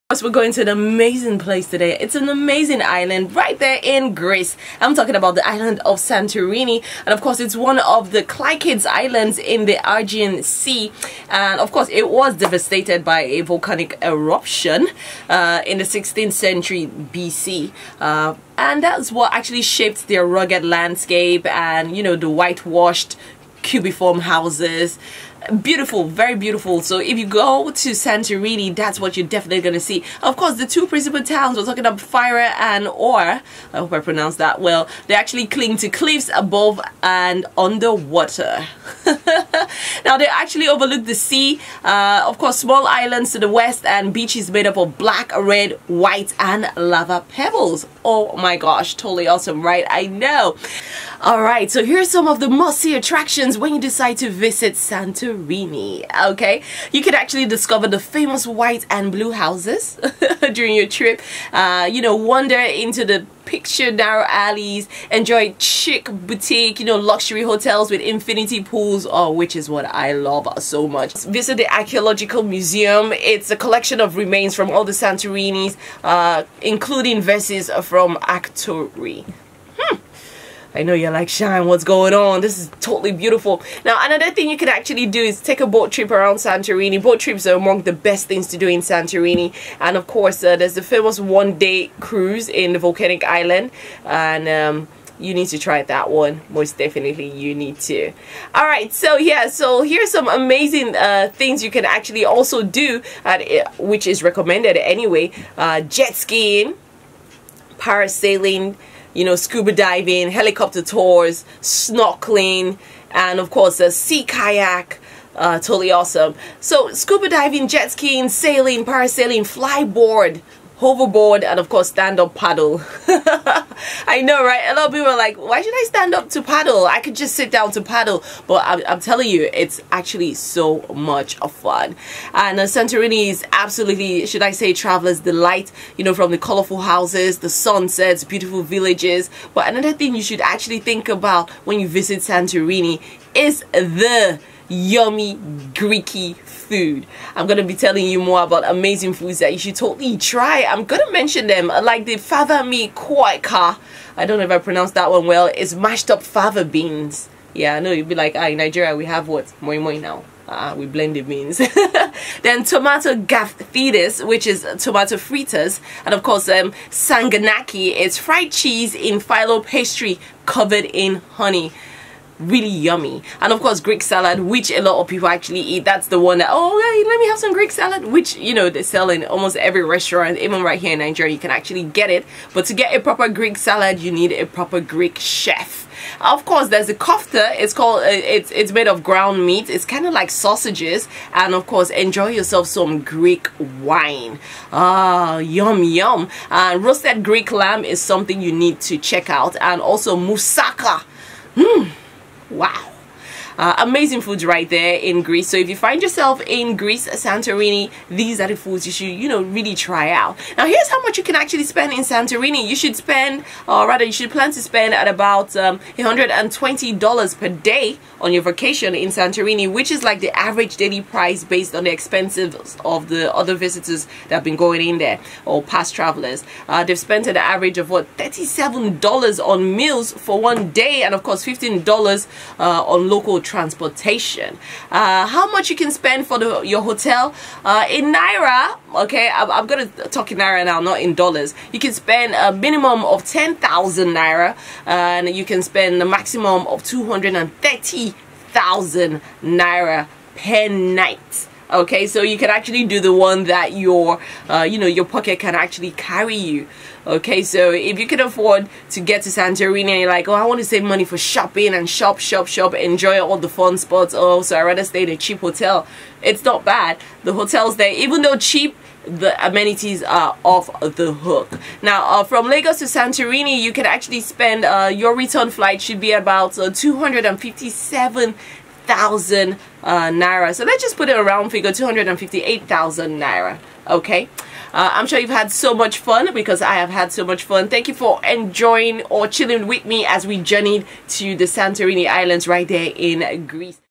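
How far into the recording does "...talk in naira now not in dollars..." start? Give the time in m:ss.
4:00.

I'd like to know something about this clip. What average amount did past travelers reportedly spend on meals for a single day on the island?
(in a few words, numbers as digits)
$37.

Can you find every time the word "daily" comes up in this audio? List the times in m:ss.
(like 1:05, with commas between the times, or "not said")
3:40.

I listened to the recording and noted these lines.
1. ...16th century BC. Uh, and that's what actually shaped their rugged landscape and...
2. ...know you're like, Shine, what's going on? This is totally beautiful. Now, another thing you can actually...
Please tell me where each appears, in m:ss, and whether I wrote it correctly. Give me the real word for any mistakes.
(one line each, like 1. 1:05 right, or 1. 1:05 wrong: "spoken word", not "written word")
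1. 0:15 right
2. 1:20 right.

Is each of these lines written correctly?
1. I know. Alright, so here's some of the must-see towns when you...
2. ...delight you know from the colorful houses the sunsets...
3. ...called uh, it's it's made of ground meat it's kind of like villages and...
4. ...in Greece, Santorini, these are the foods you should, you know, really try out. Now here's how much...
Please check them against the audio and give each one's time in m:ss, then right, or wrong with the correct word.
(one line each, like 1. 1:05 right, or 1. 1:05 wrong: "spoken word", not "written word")
1. 0:49 wrong: "attractions", not "towns"
2. 2:15 right
3. 3:07 wrong: "sausages", not "villages"
4. 3:26 right.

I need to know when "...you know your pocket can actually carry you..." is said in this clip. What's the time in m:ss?
4:14.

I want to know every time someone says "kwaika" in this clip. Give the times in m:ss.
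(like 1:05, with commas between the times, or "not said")
2:32.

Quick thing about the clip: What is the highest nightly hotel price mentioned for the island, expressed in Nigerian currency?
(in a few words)
230,000 naira.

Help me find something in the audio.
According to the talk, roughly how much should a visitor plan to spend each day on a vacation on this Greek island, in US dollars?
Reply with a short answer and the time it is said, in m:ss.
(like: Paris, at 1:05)
$120, at 3:35.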